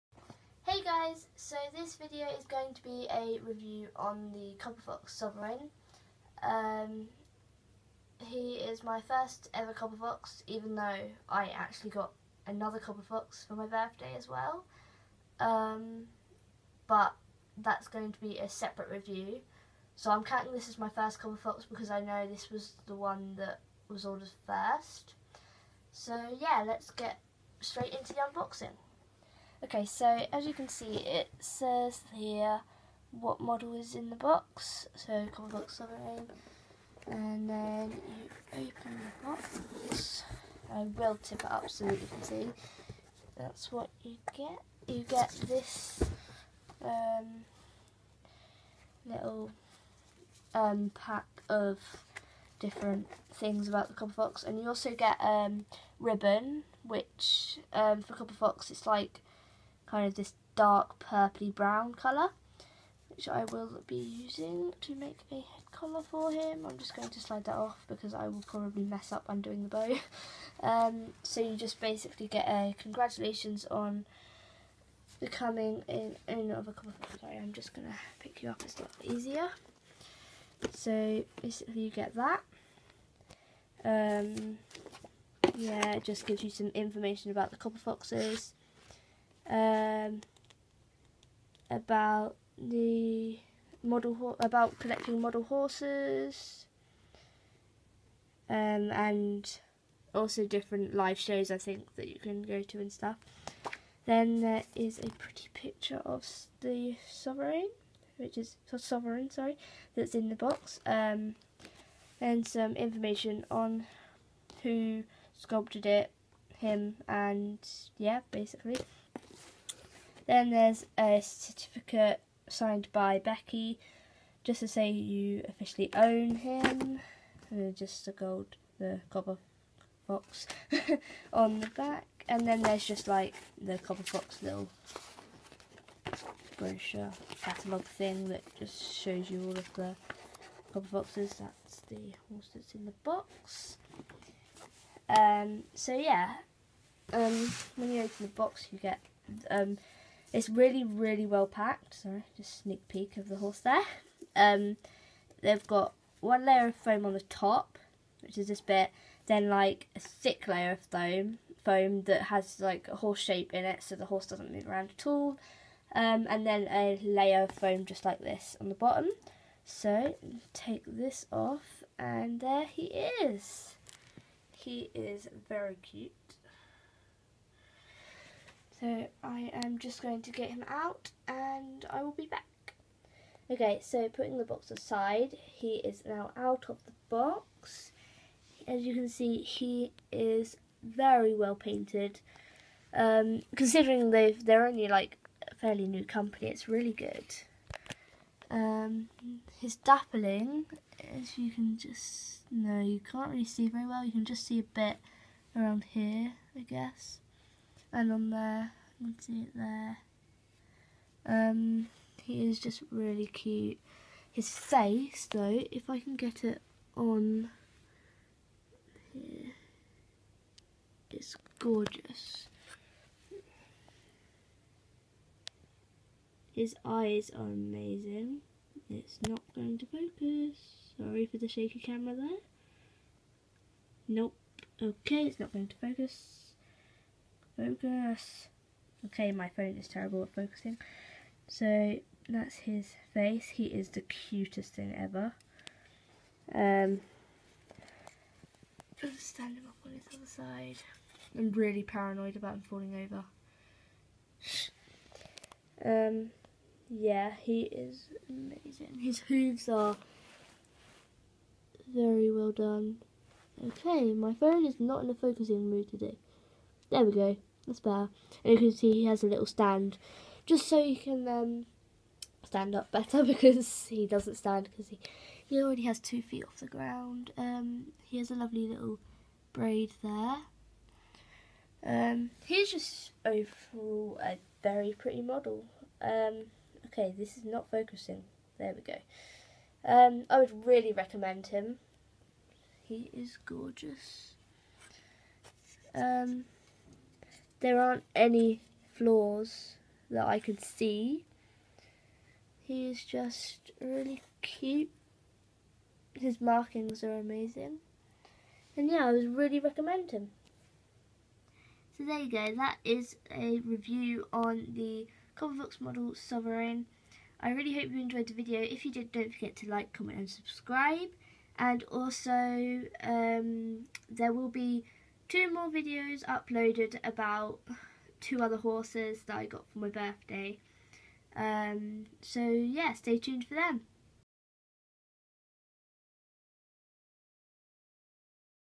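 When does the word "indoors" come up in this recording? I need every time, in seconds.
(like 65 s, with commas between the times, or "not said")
not said.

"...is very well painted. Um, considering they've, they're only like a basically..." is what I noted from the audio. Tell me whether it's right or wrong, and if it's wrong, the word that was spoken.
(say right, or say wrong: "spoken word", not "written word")
wrong: "fairly", not "basically".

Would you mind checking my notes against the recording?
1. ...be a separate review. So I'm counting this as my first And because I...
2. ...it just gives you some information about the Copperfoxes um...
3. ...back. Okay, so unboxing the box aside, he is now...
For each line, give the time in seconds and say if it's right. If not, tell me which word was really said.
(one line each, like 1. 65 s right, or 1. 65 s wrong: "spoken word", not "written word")
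1. 18 s wrong: "Copperfox", not "And"
2. 85 s right
3. 182 s wrong: "putting", not "unboxing".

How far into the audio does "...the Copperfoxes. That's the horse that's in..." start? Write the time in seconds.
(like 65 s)
139 s.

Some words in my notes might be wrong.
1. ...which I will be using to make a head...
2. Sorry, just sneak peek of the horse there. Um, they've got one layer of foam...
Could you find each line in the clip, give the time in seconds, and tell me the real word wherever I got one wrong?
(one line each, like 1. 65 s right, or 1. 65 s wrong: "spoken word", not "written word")
1. 63 s right
2. 151 s right.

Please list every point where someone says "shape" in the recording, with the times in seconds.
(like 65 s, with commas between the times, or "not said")
163 s.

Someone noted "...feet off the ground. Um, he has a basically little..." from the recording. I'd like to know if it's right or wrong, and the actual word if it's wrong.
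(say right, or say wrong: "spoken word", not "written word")
wrong: "lovely", not "basically".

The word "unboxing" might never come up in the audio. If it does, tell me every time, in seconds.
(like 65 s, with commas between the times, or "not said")
28 s.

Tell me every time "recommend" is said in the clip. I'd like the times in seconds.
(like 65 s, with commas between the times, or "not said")
290 s, 309 s.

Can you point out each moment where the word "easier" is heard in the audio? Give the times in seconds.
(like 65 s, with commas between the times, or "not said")
79 s.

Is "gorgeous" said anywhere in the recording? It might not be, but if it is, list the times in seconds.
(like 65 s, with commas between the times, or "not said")
221 s, 293 s.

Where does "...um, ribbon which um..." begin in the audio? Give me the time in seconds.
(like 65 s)
55 s.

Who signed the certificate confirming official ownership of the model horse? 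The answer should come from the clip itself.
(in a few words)
Becky.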